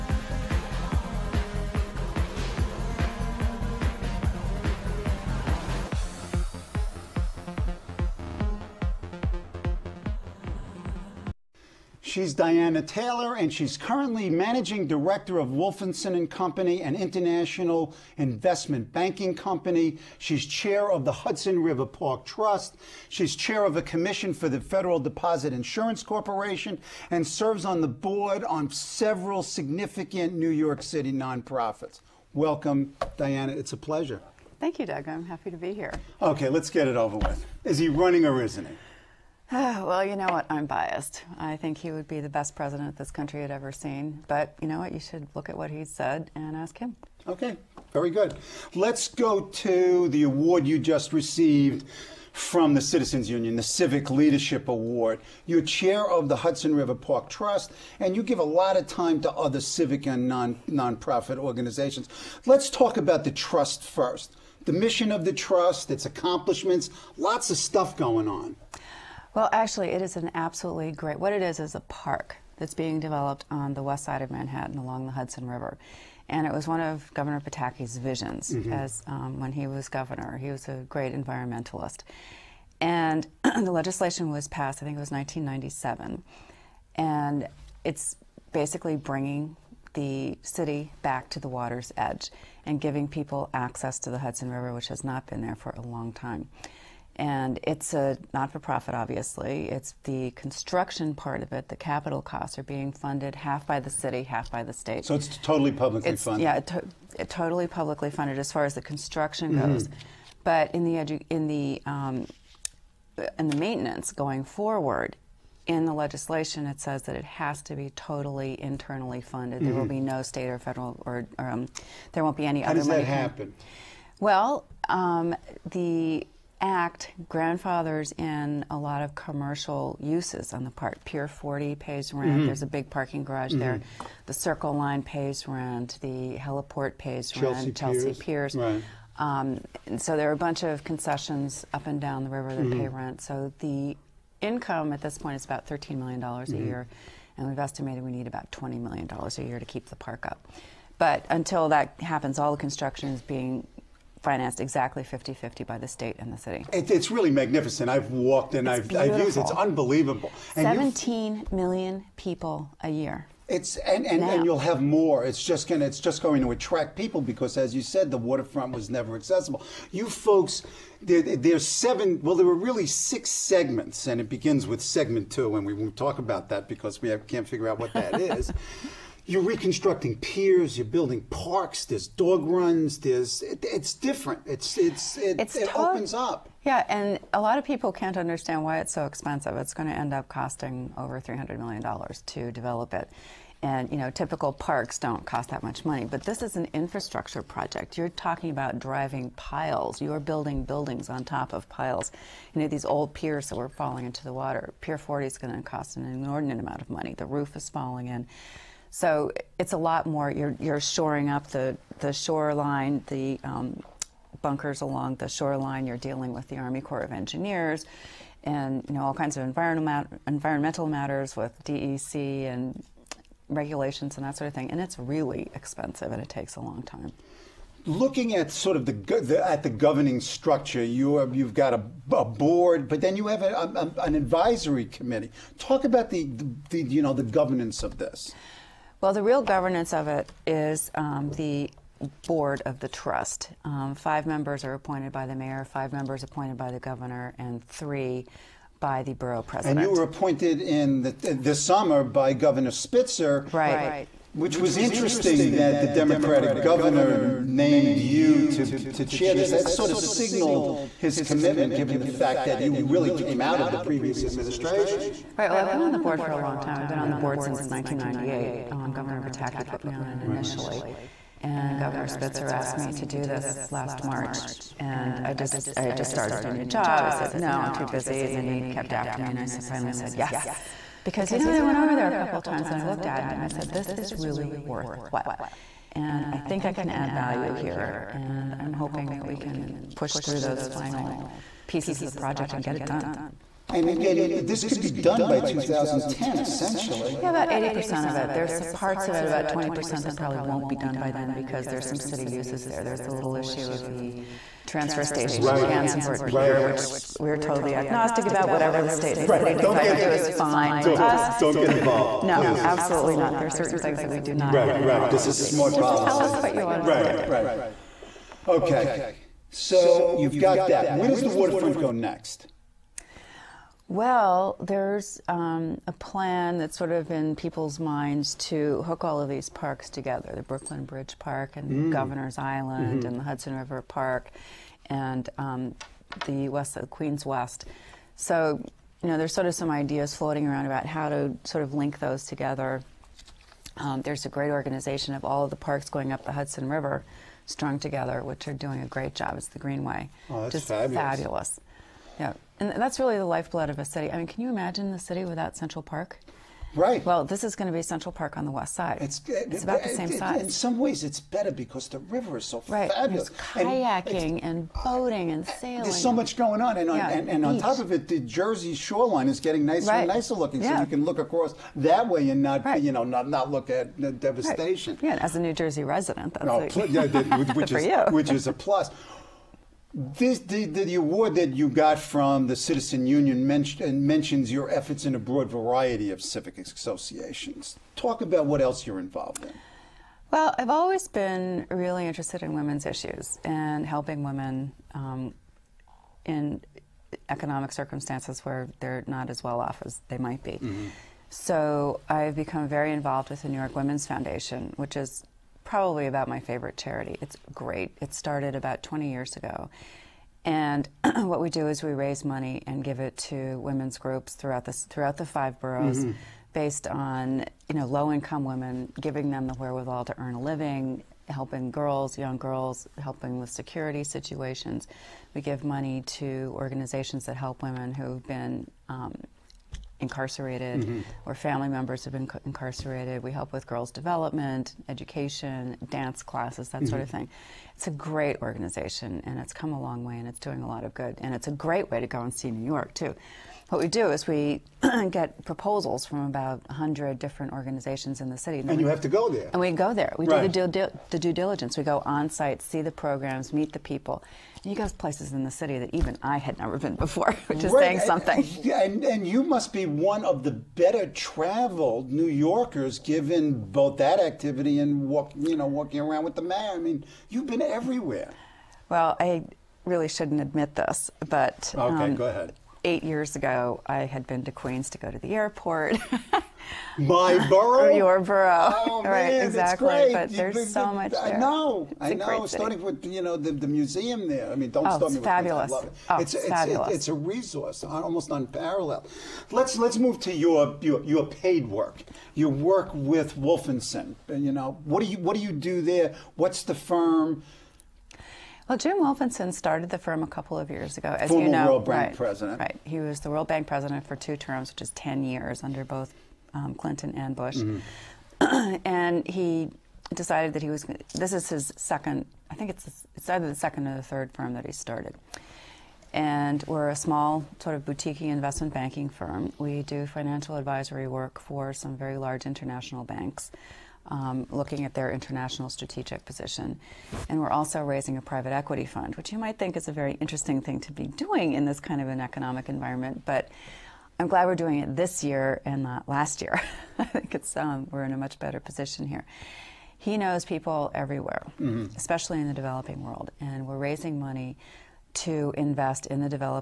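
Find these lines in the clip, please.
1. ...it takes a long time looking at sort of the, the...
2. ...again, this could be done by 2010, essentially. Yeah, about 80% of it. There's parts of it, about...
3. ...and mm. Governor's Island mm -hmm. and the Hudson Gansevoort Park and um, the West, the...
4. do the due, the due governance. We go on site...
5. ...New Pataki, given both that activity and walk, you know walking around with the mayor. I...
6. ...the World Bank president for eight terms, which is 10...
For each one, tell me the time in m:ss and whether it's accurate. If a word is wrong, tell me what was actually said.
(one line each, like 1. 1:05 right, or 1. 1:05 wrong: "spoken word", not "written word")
1. 3:46 right
2. 4:53 right
3. 5:31 wrong: "River", not "Gansevoort"
4. 7:30 wrong: "diligence", not "governance"
5. 7:42 wrong: "Yorkers", not "Pataki"
6. 8:23 wrong: "two", not "eight".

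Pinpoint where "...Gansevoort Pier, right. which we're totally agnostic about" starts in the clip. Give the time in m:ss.
5:05.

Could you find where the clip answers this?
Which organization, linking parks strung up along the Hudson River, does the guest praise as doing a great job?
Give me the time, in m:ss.
5:49.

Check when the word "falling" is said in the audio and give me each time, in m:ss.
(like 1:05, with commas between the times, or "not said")
3:23, 3:27.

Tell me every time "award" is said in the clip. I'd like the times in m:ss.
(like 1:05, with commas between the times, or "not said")
0:50, 0:54, 6:20.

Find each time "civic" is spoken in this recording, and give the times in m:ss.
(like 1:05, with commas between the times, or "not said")
0:53, 0:59, 6:26.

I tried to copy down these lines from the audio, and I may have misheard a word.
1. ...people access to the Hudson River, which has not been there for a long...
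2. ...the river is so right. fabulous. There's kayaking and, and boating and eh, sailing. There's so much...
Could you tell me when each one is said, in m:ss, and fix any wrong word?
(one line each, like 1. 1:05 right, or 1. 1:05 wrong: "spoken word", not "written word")
1. 1:33 right
2. 6:01 right.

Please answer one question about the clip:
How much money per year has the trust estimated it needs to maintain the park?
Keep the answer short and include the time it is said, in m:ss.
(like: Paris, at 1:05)
$20 million, at 2:28.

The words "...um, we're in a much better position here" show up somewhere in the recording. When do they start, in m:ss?
8:57.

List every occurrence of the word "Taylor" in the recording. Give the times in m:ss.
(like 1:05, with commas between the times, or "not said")
0:12.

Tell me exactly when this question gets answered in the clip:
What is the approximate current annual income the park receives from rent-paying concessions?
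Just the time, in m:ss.
2:25.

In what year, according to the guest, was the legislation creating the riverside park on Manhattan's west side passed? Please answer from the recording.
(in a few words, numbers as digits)
1997.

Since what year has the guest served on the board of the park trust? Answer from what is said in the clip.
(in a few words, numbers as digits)
1998.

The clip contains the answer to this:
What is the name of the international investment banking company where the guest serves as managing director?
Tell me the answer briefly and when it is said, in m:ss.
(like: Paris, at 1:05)
Wolfensohn and Company, at 0:15.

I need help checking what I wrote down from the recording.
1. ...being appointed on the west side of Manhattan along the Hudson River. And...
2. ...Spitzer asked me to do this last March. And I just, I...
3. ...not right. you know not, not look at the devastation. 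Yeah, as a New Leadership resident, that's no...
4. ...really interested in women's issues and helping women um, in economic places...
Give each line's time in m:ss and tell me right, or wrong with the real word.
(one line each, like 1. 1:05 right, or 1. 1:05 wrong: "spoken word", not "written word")
1. 1:12 wrong: "developed", not "appointed"
2. 4:32 right
3. 6:12 wrong: "Jersey", not "Leadership"
4. 6:31 wrong: "circumstances", not "places".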